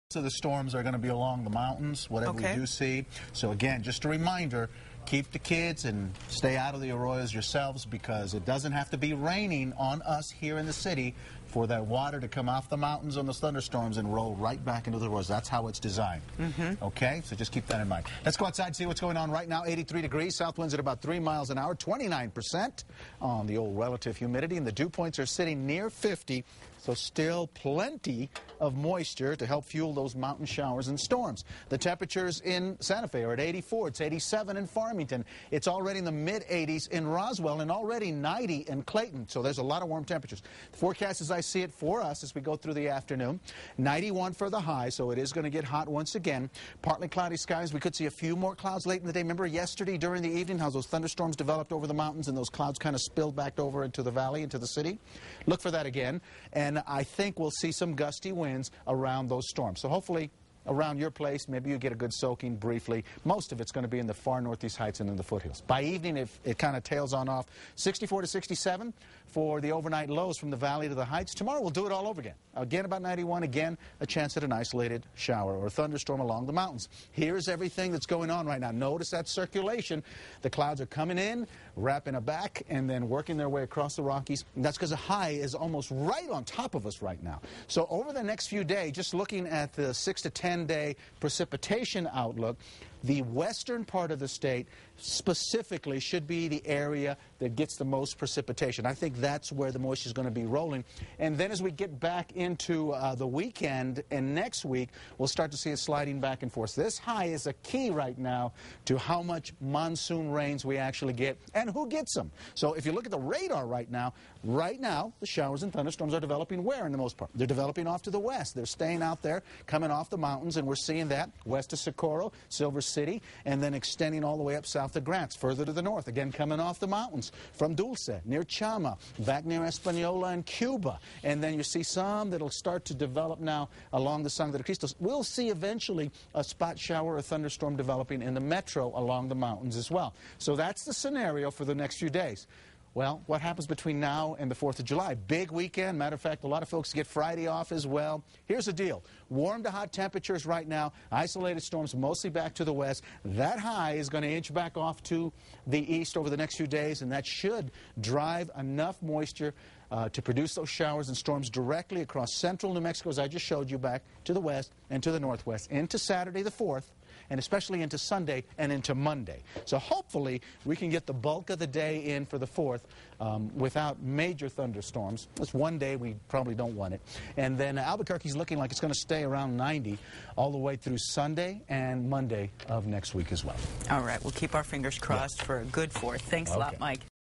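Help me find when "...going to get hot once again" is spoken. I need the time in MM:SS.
00:45.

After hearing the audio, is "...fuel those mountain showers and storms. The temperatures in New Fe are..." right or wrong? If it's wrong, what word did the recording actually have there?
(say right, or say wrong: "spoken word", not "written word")
wrong: "Santa", not "New".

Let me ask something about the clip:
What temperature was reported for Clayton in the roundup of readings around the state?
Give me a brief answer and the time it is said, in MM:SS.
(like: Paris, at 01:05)
90, at 00:37.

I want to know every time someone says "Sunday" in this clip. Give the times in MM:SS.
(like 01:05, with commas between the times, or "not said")
02:47, 03:00.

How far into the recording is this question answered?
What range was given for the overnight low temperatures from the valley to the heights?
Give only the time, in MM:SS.
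01:07.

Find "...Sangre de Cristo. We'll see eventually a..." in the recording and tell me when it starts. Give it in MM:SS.
02:14.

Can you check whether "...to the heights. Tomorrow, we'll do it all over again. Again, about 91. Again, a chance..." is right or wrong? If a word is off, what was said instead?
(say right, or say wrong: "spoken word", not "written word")
right.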